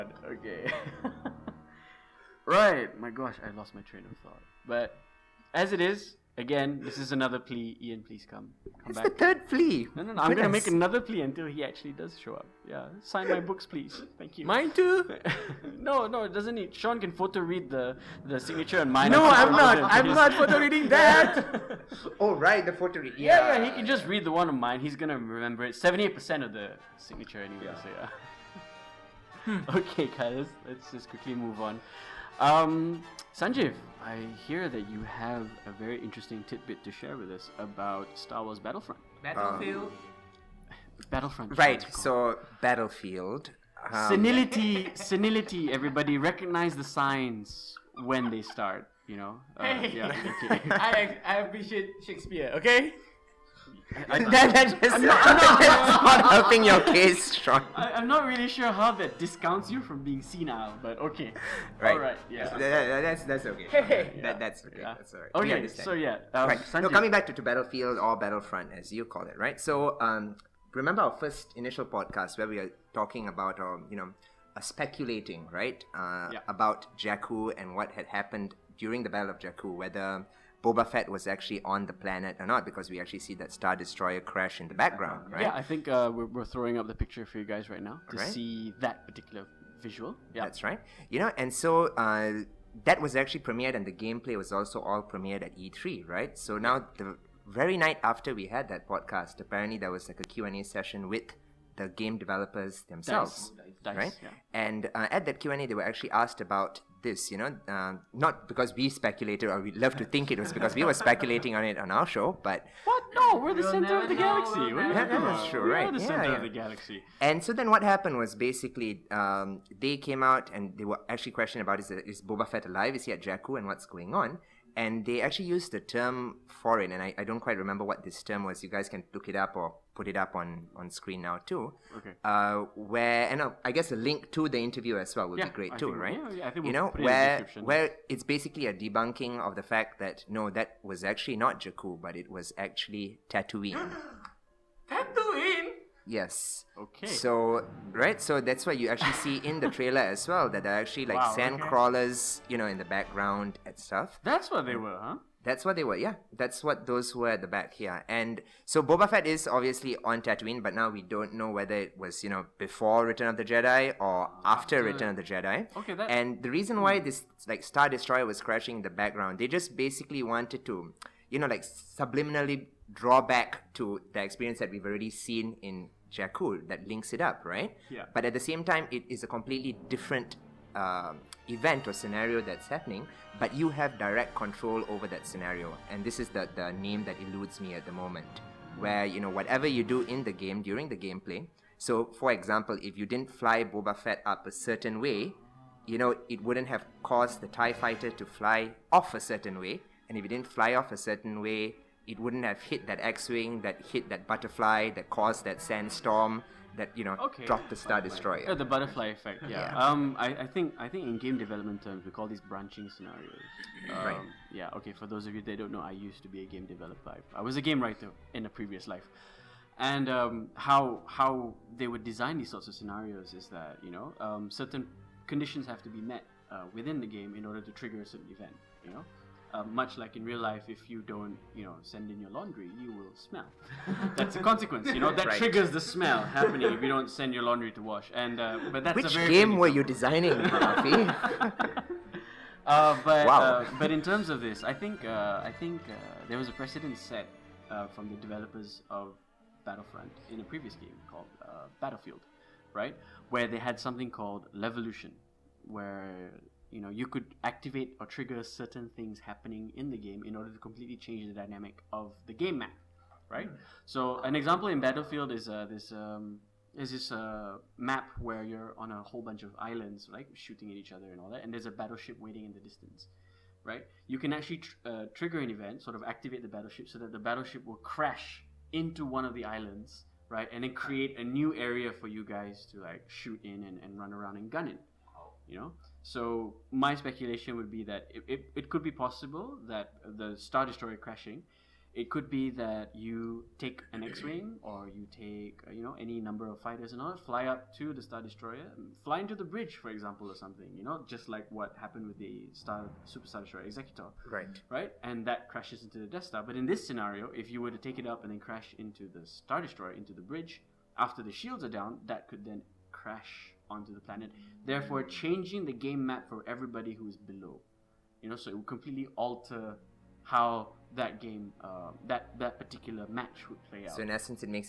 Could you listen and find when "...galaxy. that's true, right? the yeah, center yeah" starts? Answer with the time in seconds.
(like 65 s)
114 s.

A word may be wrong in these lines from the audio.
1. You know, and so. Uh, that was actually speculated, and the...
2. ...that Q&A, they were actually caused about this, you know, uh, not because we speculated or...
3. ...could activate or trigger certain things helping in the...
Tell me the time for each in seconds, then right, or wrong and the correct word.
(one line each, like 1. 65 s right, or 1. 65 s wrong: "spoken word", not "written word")
1. 91 s wrong: "premiered", not "speculated"
2. 105 s wrong: "asked", not "caused"
3. 257 s wrong: "happening", not "helping".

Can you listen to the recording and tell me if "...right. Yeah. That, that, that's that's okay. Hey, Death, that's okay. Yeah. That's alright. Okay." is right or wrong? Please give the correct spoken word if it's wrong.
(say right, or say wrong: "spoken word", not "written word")
wrong: "That", not "Death".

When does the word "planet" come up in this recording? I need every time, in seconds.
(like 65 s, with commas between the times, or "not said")
81 s, 313 s.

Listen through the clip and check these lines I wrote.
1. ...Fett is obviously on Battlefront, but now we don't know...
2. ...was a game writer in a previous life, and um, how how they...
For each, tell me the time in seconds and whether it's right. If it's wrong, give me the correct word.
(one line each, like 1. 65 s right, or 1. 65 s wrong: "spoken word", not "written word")
1. 159 s wrong: "Tatooine", not "Battlefront"
2. 217 s right.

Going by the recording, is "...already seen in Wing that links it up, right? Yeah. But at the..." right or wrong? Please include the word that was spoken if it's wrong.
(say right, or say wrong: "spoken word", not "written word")
wrong: "Jakku", not "Wing".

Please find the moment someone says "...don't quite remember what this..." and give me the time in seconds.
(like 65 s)
127 s.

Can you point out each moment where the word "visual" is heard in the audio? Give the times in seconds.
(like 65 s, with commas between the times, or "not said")
89 s.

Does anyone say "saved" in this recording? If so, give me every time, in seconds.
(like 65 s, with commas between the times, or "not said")
not said.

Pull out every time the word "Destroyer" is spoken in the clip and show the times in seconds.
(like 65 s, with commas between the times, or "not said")
83 s, 167 s, 207 s, 290 s, 298 s, 303 s, 309 s.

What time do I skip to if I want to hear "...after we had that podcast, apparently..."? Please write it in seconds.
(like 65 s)
98 s.